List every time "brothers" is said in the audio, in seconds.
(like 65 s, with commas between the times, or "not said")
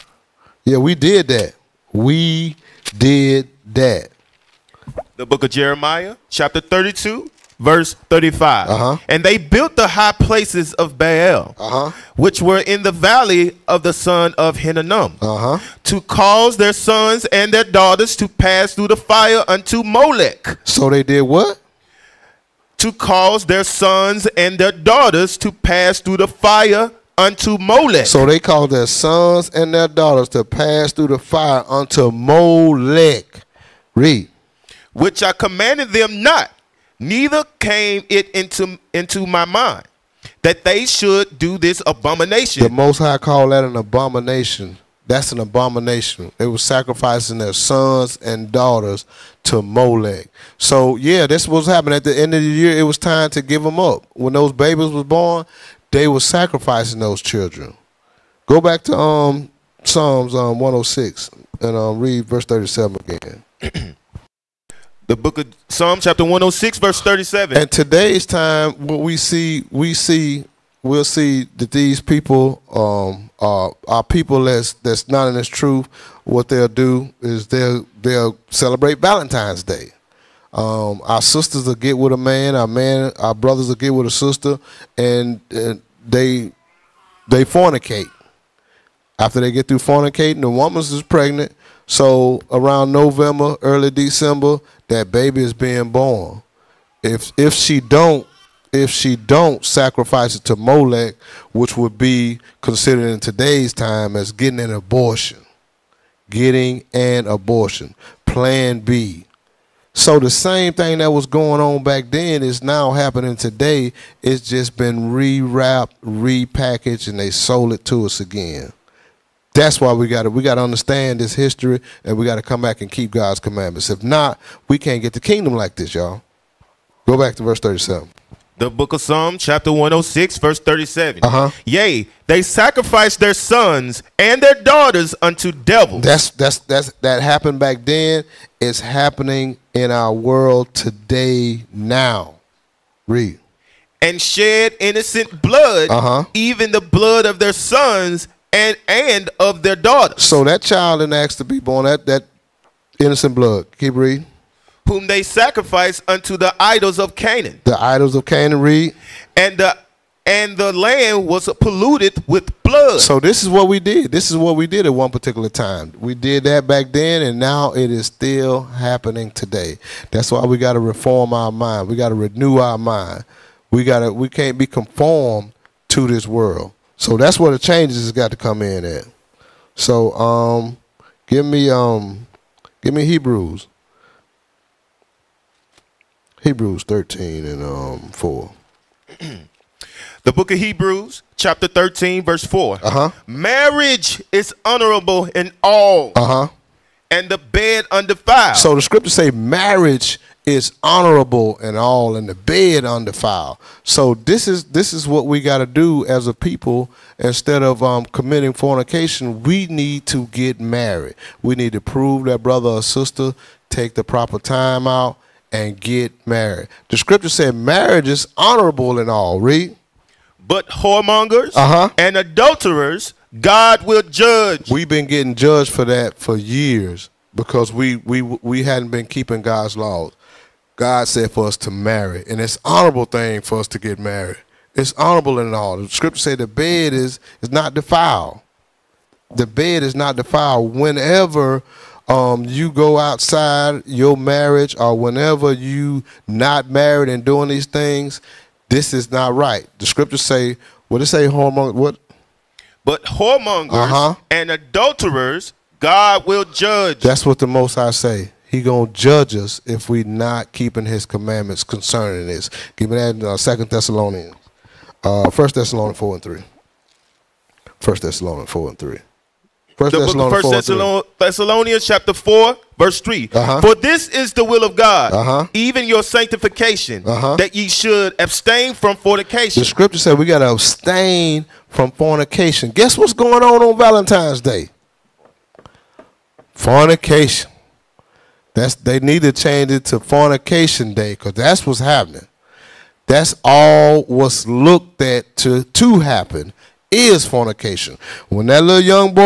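83 s, 212 s.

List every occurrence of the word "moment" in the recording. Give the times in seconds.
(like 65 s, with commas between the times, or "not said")
not said.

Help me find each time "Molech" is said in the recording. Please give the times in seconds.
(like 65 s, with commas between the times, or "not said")
19 s, 27 s, 32 s, 49 s, 100 s.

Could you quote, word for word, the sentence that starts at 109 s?
So the same thing that was going on back then is now happening today.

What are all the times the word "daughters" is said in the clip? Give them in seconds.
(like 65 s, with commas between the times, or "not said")
17 s, 24 s, 29 s, 48 s, 134 s, 149 s.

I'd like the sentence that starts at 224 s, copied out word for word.
We've been getting judged for that for years because we we we hadn't been keeping God's laws.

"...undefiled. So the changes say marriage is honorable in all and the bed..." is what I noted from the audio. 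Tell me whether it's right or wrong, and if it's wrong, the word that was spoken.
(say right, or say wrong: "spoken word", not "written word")
wrong: "scriptures", not "changes".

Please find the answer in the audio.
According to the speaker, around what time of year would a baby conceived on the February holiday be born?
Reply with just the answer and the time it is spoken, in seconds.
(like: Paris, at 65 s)
Early December, at 93 s.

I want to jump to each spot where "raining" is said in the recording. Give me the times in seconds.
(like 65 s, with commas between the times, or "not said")
not said.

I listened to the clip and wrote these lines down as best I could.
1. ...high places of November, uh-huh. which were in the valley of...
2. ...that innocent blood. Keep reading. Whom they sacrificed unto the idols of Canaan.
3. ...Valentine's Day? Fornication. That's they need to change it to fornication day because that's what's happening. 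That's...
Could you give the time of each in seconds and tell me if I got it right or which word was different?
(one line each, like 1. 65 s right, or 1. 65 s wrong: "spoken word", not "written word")
1. 9 s wrong: "Baal", not "November"
2. 152 s right
3. 283 s right.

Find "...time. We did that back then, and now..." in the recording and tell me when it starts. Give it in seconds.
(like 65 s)
165 s.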